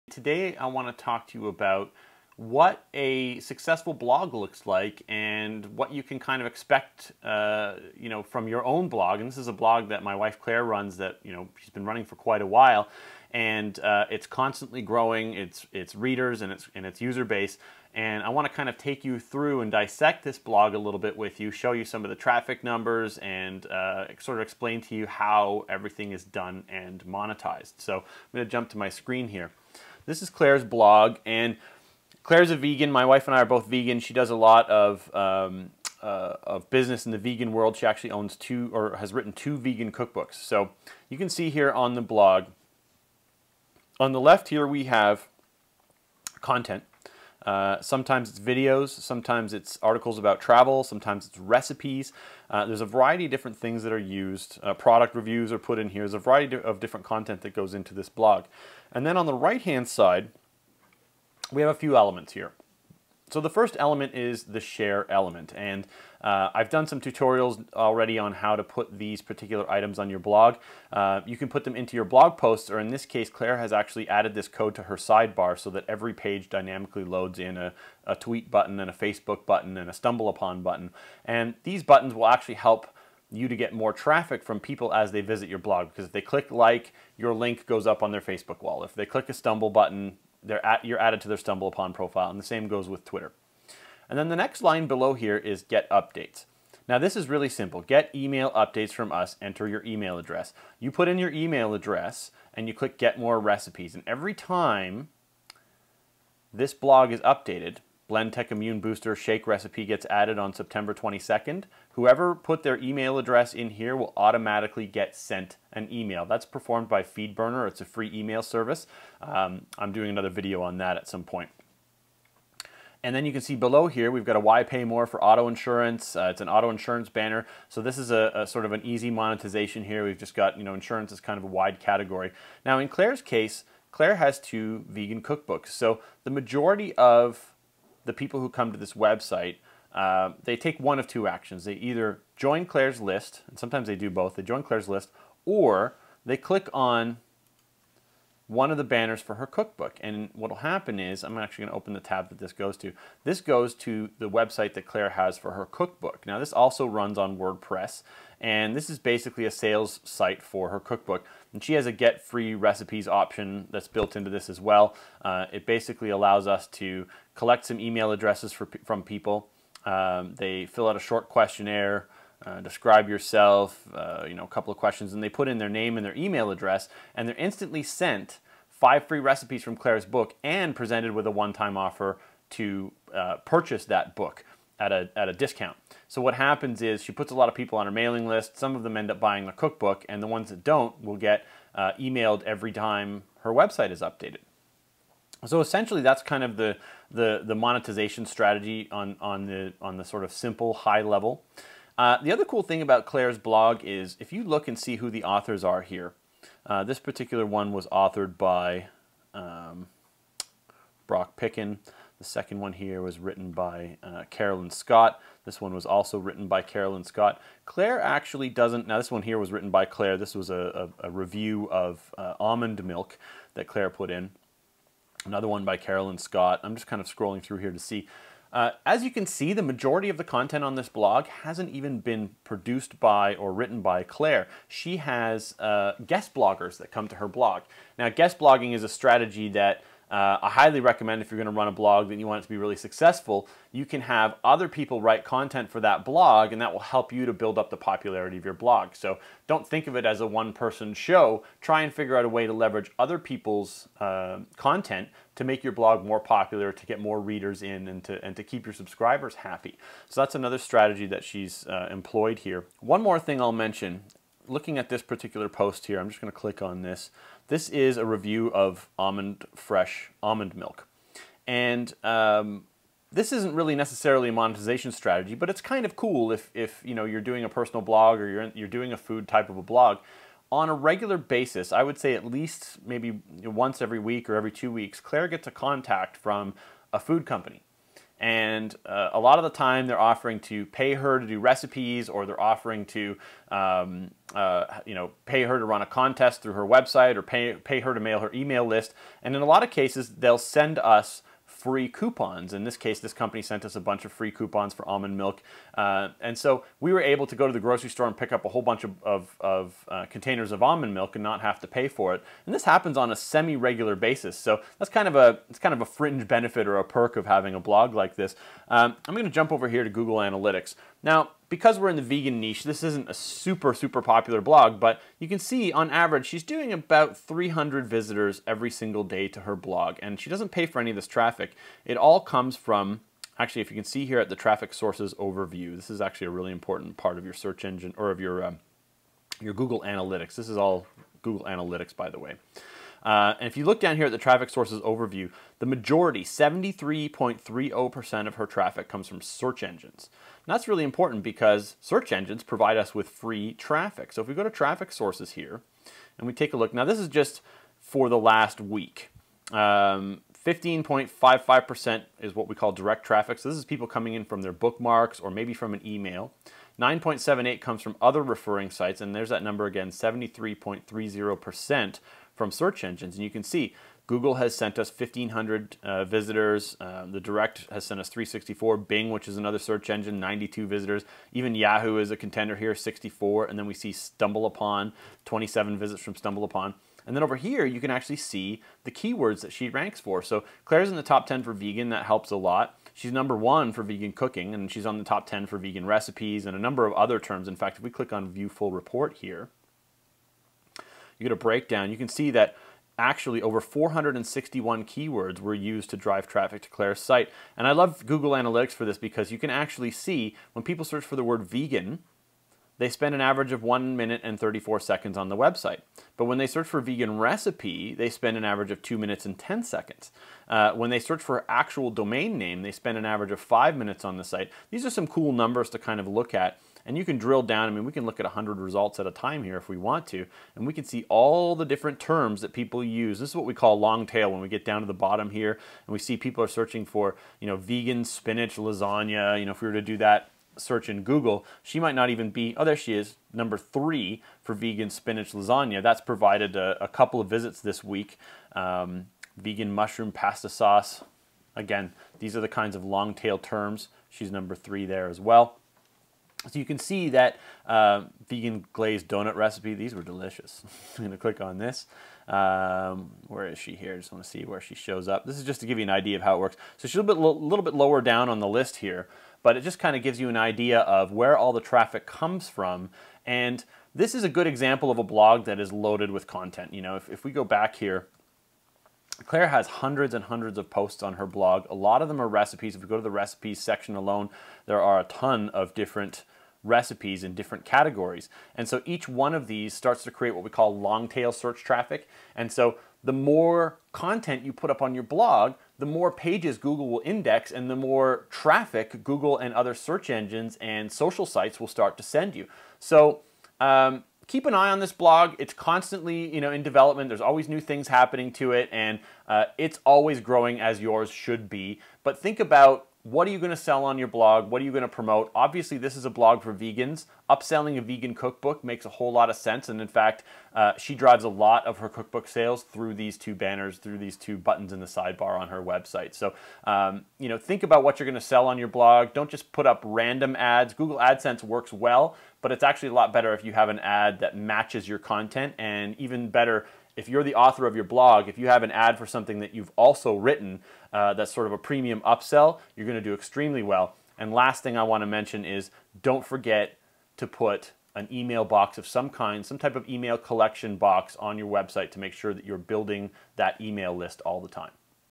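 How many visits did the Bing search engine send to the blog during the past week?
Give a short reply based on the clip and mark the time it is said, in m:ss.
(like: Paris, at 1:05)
92, at 6:20.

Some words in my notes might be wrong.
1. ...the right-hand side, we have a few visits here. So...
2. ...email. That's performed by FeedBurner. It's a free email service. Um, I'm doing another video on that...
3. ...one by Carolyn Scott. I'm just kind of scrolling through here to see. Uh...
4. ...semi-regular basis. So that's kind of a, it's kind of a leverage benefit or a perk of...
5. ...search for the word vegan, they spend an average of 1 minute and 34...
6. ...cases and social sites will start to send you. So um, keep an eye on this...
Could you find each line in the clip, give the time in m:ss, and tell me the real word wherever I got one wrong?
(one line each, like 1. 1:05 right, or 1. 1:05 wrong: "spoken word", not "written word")
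1. 0:59 wrong: "elements", not "visits"
2. 1:55 right
3. 3:45 right
4. 5:13 wrong: "fringe", not "leverage"
5. 6:50 right
6. 8:20 wrong: "engines", not "cases".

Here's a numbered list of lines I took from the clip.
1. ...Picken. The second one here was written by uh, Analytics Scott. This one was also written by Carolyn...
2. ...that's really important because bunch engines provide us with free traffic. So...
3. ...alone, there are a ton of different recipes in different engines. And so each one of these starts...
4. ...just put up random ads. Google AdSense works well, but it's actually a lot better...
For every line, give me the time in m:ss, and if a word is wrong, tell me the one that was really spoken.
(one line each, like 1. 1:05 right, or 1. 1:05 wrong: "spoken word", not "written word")
1. 3:31 wrong: "Carolyn", not "Analytics"
2. 5:50 wrong: "search", not "bunch"
3. 8:03 wrong: "categories", not "engines"
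4. 8:49 right.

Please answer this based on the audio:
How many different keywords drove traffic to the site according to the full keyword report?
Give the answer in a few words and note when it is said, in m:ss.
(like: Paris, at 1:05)
461, at 6:43.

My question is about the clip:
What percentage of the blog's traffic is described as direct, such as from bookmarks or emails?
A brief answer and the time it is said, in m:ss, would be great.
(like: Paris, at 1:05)
15.55%, at 5:59.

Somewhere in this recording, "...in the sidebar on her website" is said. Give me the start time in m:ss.
8:44.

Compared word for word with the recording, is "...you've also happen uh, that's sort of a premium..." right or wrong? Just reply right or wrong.
wrong.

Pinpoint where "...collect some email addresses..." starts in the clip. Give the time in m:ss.
2:47.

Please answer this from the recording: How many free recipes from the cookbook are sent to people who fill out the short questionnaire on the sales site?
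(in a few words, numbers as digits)
5.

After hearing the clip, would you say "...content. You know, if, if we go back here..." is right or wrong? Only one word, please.
right.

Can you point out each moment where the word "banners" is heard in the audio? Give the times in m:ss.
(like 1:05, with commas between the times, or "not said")
2:07, 2:28, 8:43.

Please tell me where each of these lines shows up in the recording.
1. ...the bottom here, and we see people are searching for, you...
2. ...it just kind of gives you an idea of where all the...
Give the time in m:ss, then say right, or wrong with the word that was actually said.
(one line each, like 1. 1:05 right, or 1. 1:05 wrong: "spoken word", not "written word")
1. 7:14 right
2. 7:49 right.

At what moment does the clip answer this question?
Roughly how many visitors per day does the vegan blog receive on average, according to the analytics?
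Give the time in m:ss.
5:27.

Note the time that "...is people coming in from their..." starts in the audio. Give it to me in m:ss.
6:03.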